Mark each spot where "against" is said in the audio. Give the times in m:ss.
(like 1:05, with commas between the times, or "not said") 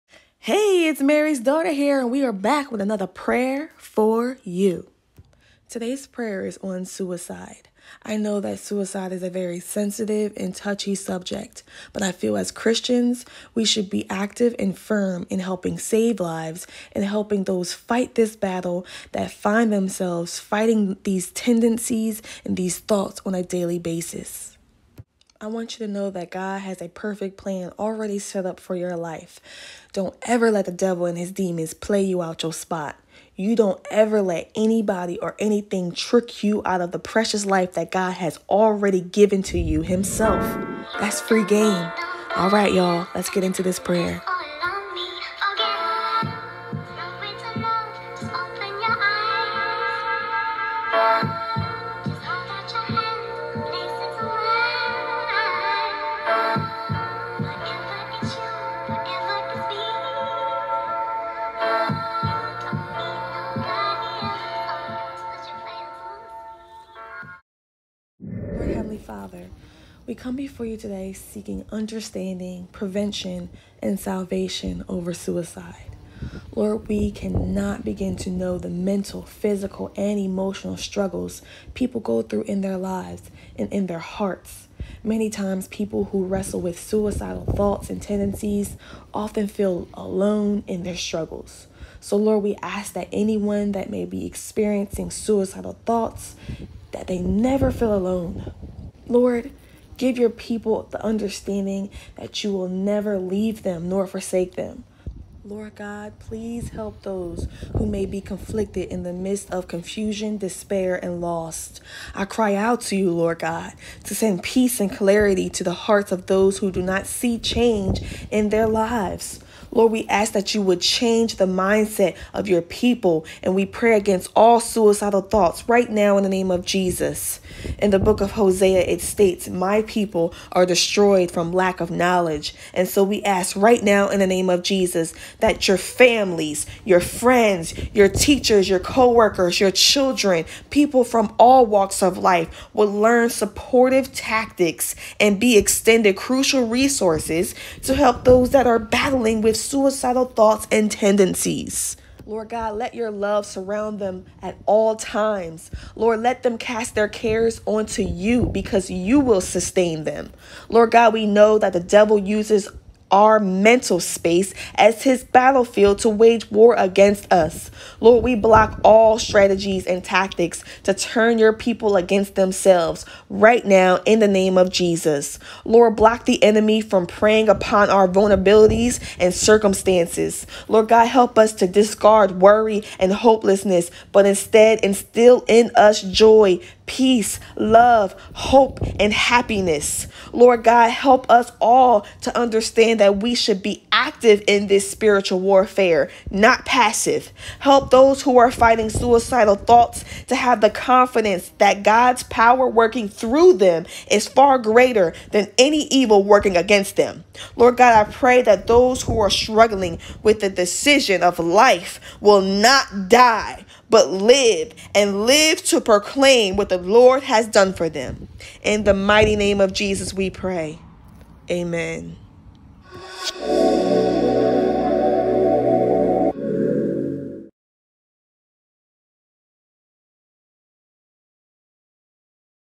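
2:03, 2:46, 2:51, 3:26.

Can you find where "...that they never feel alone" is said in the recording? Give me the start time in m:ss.
1:36.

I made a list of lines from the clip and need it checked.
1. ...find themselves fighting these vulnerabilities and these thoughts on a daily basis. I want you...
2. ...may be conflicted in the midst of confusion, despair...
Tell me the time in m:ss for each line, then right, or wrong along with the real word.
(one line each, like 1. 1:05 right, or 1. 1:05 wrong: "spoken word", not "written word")
1. 0:19 wrong: "tendencies", not "vulnerabilities"
2. 1:47 right.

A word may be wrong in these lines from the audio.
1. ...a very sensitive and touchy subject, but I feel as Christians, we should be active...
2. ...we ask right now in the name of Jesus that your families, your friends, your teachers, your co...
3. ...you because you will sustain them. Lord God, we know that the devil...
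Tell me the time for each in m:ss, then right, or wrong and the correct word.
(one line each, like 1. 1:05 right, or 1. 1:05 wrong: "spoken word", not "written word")
1. 0:09 right
2. 2:13 right
3. 2:38 right.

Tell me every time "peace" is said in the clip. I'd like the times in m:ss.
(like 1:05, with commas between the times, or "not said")
1:54, 3:06.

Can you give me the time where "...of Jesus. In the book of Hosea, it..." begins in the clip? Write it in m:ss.
2:06.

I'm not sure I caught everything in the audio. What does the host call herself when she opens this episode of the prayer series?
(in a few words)
Mary's daughter.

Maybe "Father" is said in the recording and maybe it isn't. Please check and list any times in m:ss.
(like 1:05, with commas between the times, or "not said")
1:09.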